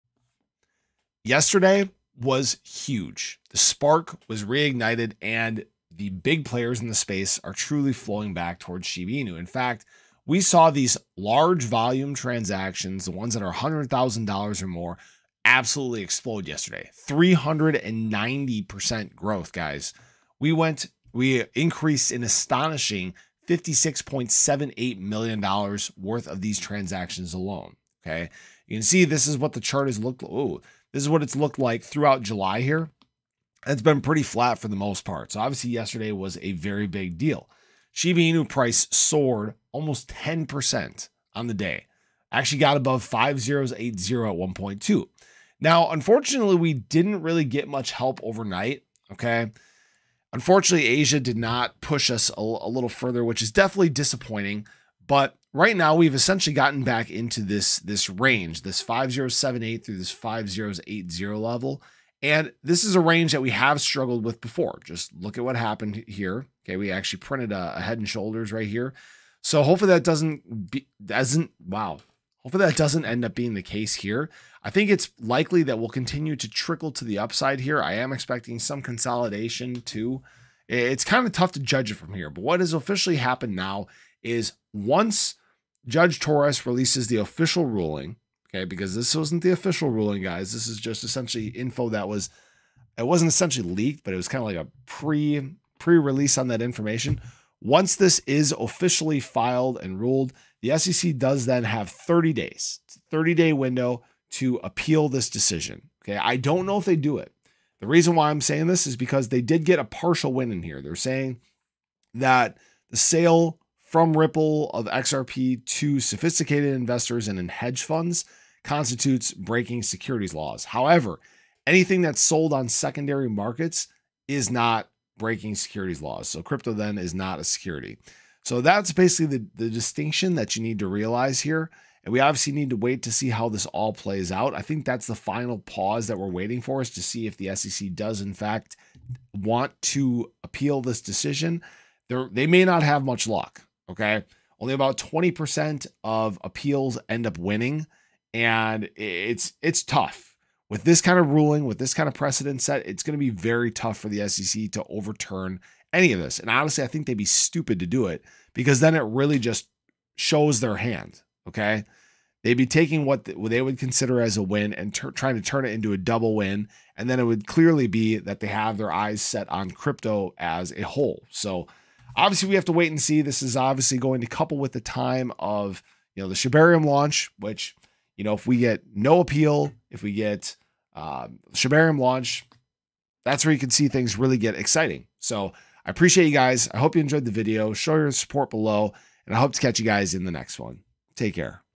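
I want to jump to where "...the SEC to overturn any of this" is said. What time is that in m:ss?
2:34.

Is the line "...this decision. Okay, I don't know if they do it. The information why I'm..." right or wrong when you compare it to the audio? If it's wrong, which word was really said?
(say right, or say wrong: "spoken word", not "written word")
wrong: "reason", not "information".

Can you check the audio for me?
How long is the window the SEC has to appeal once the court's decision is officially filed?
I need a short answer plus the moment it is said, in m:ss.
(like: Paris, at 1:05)
30 days, at 1:41.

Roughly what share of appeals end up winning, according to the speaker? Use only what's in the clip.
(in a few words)
20%.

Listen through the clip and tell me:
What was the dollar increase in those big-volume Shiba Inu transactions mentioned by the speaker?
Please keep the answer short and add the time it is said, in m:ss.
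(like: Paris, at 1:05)
$56.78 million, at 0:23.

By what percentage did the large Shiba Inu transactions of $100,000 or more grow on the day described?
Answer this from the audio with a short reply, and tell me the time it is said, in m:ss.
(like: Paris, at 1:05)
390%, at 0:17.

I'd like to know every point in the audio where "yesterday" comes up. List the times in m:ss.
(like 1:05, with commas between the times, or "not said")
0:01, 0:16, 0:35.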